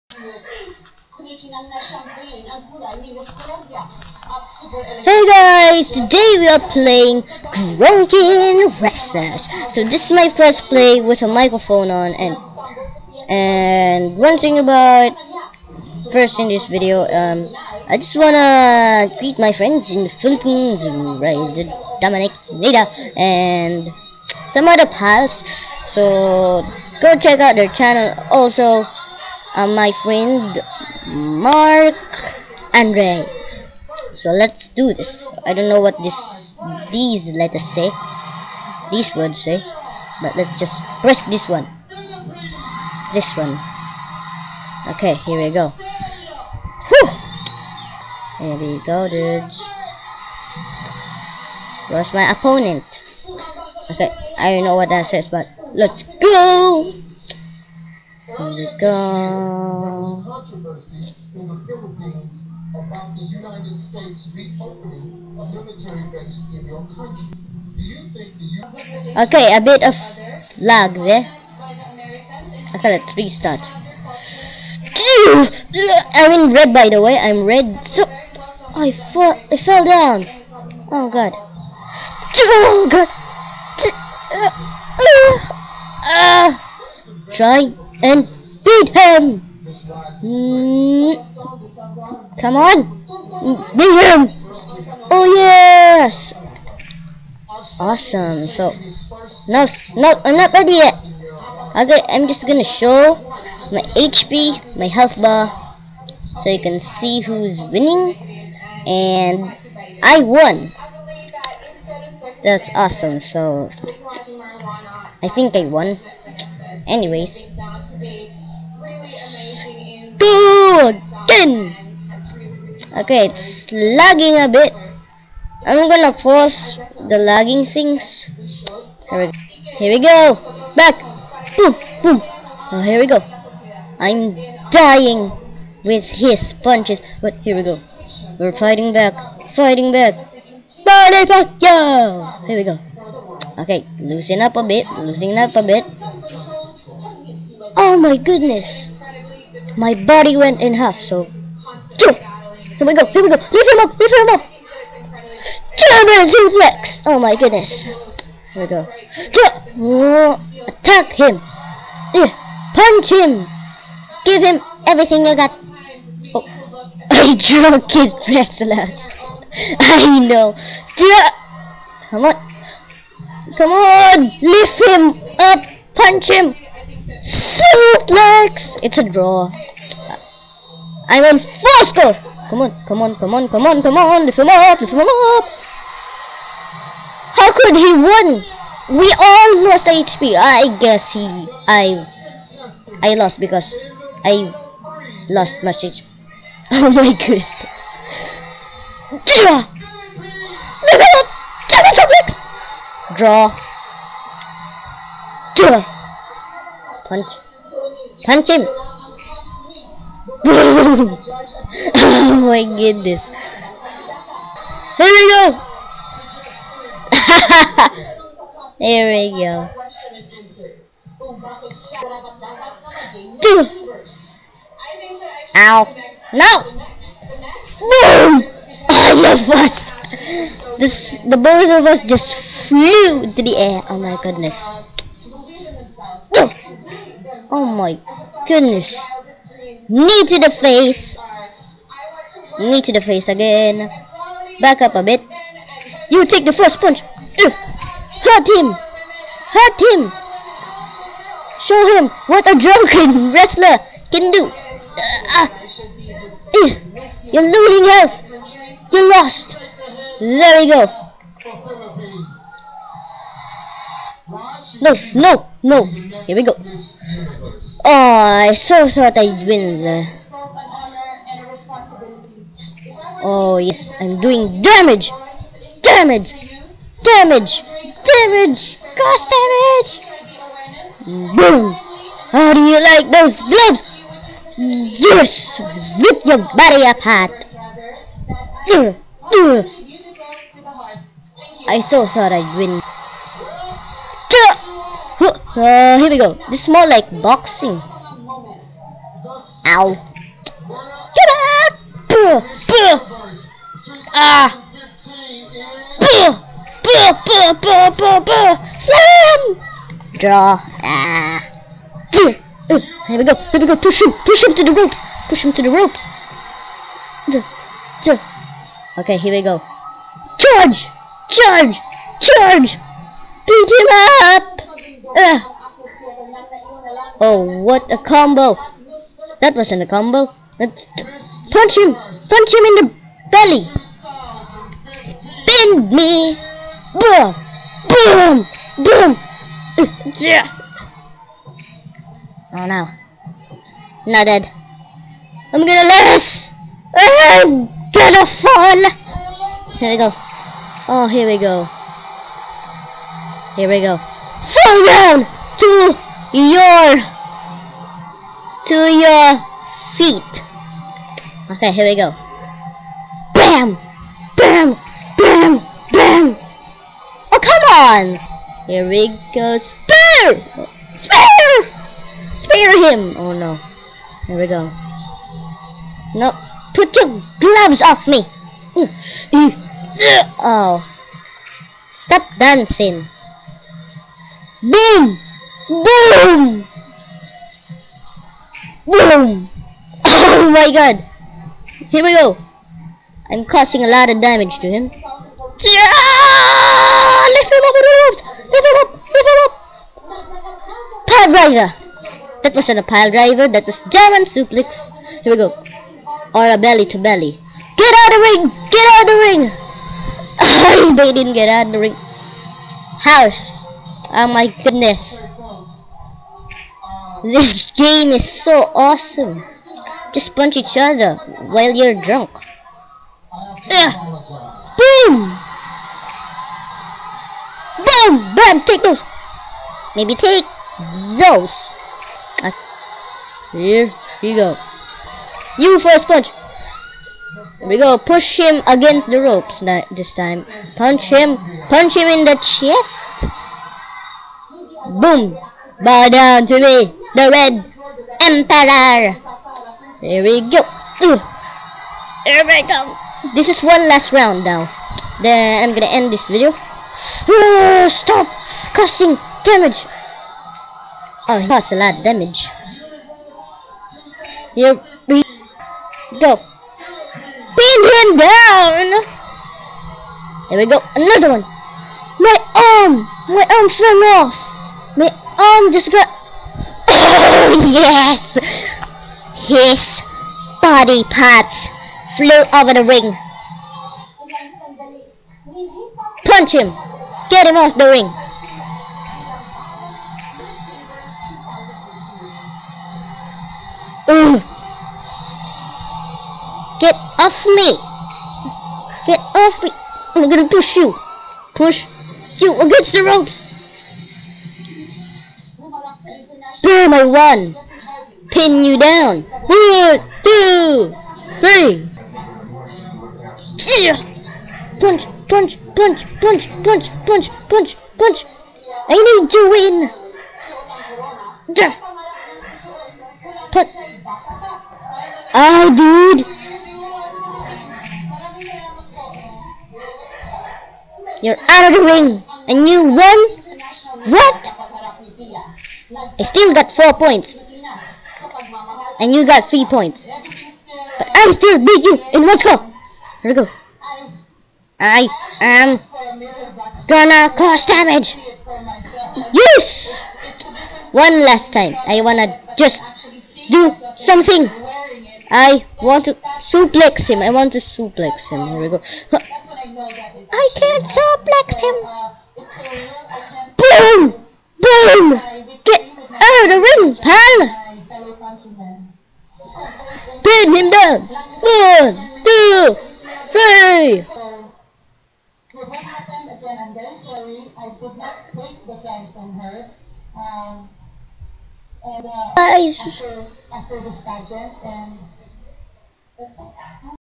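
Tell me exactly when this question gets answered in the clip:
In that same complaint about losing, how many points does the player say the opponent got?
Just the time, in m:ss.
8:59.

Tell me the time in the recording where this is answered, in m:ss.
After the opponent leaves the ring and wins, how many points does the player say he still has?
8:56.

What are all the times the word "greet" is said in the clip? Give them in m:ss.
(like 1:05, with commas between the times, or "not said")
0:19.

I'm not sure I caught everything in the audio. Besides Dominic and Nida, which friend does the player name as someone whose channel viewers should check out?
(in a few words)
Mark Andre.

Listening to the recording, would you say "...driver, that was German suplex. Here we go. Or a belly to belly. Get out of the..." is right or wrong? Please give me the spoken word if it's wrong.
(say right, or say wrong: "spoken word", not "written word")
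right.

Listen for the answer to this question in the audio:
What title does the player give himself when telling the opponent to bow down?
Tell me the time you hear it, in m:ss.
7:27.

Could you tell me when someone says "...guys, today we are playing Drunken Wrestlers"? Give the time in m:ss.
0:05.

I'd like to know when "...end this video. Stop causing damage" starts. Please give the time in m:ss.
7:35.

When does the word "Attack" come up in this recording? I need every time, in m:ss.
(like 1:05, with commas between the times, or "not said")
2:40.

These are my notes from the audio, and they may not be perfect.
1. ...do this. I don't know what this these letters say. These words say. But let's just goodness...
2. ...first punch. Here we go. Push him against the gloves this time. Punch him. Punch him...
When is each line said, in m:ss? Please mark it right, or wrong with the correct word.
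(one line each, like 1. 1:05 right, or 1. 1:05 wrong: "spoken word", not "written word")
1. 0:34 wrong: "press", not "goodness"
2. 7:15 wrong: "ropes", not "gloves".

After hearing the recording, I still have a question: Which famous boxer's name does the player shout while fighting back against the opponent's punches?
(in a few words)
Manny Pacquiao.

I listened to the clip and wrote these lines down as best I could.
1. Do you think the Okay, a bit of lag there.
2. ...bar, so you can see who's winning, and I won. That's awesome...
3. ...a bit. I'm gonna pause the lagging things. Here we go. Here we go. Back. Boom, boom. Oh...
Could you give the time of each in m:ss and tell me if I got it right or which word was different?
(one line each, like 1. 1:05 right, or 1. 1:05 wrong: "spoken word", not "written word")
1. 1:07 right
2. 1:45 right
3. 2:04 right.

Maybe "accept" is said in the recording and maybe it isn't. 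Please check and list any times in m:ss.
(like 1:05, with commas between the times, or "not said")
not said.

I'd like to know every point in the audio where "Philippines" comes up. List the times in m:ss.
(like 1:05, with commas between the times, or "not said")
0:20, 1:01.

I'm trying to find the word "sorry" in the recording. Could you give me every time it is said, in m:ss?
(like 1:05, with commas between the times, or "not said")
9:36.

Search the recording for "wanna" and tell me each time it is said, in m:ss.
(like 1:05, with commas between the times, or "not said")
0:18, 9:12.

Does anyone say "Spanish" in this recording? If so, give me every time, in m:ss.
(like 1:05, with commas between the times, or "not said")
not said.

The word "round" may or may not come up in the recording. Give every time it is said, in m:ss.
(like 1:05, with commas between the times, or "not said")
7:34.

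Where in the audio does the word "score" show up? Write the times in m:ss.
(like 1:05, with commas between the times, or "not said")
3:01, 9:02.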